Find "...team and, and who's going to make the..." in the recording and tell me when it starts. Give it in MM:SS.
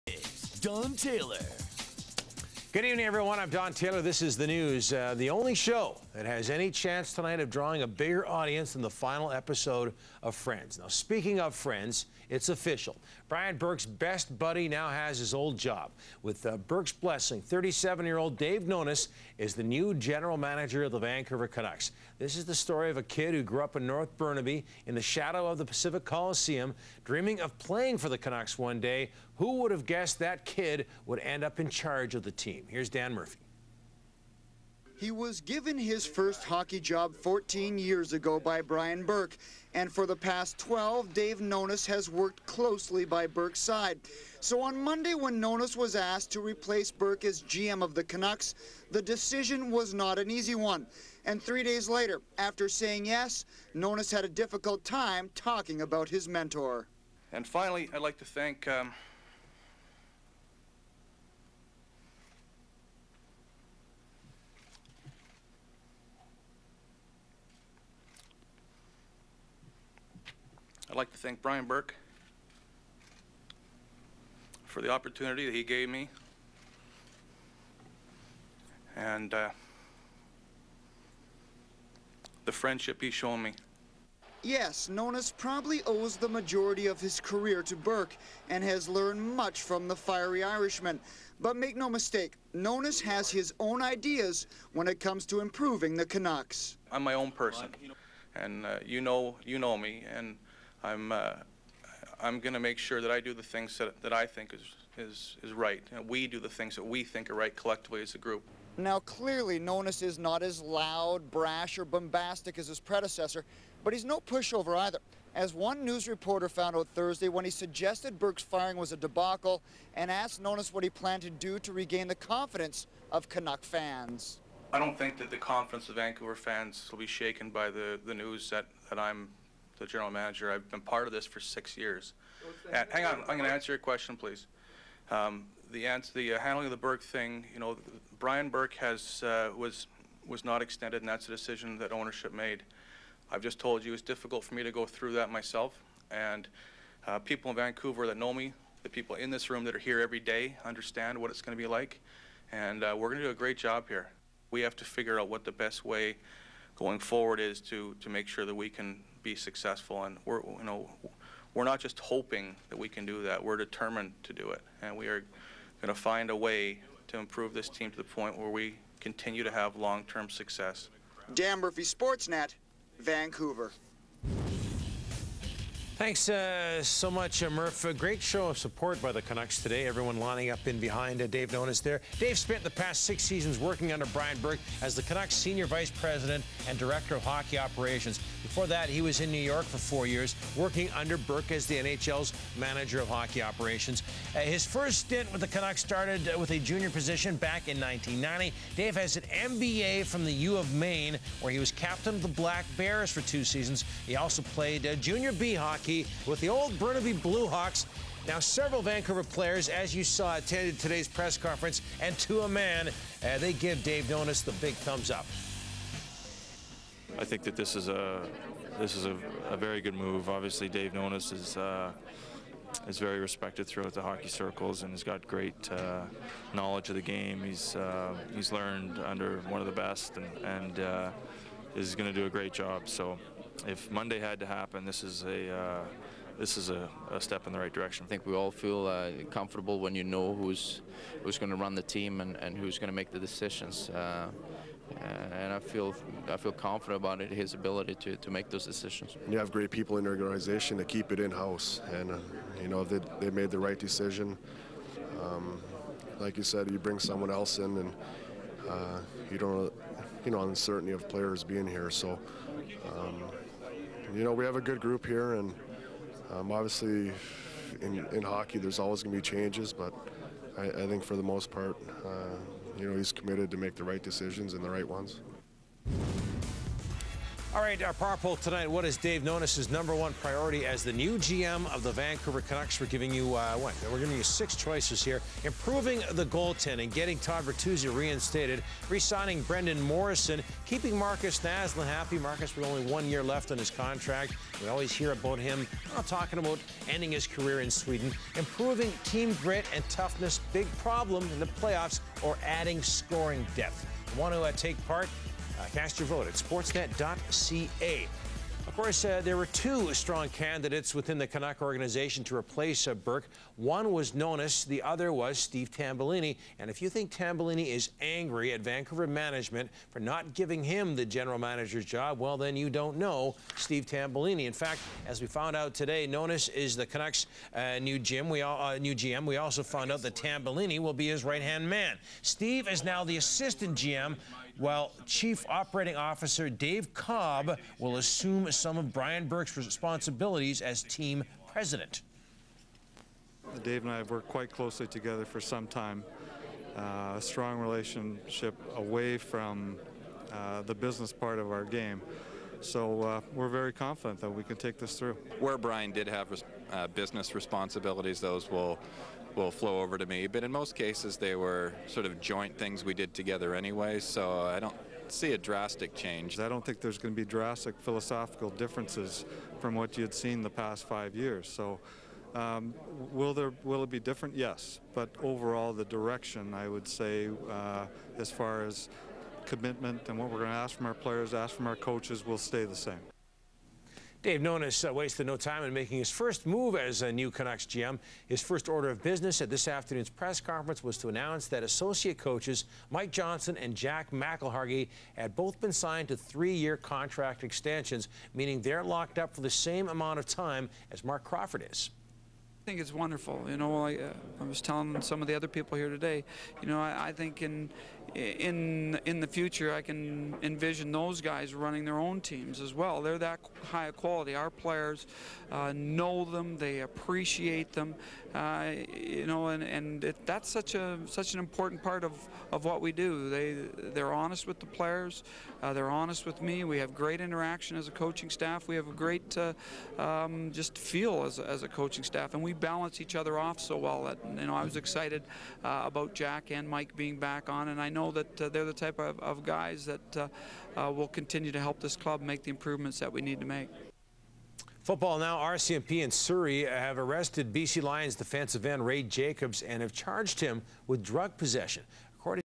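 04:01.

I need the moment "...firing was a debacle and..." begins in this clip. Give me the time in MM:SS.
01:58.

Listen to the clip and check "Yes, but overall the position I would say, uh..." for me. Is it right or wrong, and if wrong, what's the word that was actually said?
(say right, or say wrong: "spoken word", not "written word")
wrong: "direction", not "position".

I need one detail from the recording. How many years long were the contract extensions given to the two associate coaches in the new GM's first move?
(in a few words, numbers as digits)
3.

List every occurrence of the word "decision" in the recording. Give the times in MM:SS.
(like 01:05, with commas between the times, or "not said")
00:49, 02:21, 04:03, 04:08, 04:13, 04:34.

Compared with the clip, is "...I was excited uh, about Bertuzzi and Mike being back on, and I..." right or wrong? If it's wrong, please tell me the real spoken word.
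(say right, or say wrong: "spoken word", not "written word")
wrong: "Jack", not "Bertuzzi".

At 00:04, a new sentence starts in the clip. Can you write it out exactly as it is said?
Uh, the only show that has any chance tonight of drawing a bigger audience than the final episode of Friends.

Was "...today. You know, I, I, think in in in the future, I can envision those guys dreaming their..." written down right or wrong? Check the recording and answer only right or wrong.
wrong.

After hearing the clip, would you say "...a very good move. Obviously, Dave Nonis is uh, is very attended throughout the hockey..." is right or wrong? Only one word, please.
wrong.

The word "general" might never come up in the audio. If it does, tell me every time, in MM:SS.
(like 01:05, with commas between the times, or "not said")
00:19, 02:09, 05:21.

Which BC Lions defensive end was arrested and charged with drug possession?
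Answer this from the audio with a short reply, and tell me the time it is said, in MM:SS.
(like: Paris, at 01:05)
Ray Jacobs, at 07:28.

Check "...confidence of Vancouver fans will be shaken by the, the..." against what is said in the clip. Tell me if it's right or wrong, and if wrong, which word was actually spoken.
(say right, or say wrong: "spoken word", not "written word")
right.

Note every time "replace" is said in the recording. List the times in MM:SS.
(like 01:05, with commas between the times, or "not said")
00:46, 05:12.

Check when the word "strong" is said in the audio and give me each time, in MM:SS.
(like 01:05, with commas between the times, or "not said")
05:09, 05:47.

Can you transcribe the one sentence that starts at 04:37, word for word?
All right, our power poll tonight.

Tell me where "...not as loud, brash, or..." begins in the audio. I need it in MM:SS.
01:50.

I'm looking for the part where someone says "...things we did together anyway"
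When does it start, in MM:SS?
06:02.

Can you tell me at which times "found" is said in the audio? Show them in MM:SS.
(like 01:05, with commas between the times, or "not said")
01:56, 05:25, 05:29.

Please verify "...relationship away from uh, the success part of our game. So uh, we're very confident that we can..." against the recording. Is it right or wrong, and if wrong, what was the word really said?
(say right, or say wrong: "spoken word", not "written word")
wrong: "business", not "success".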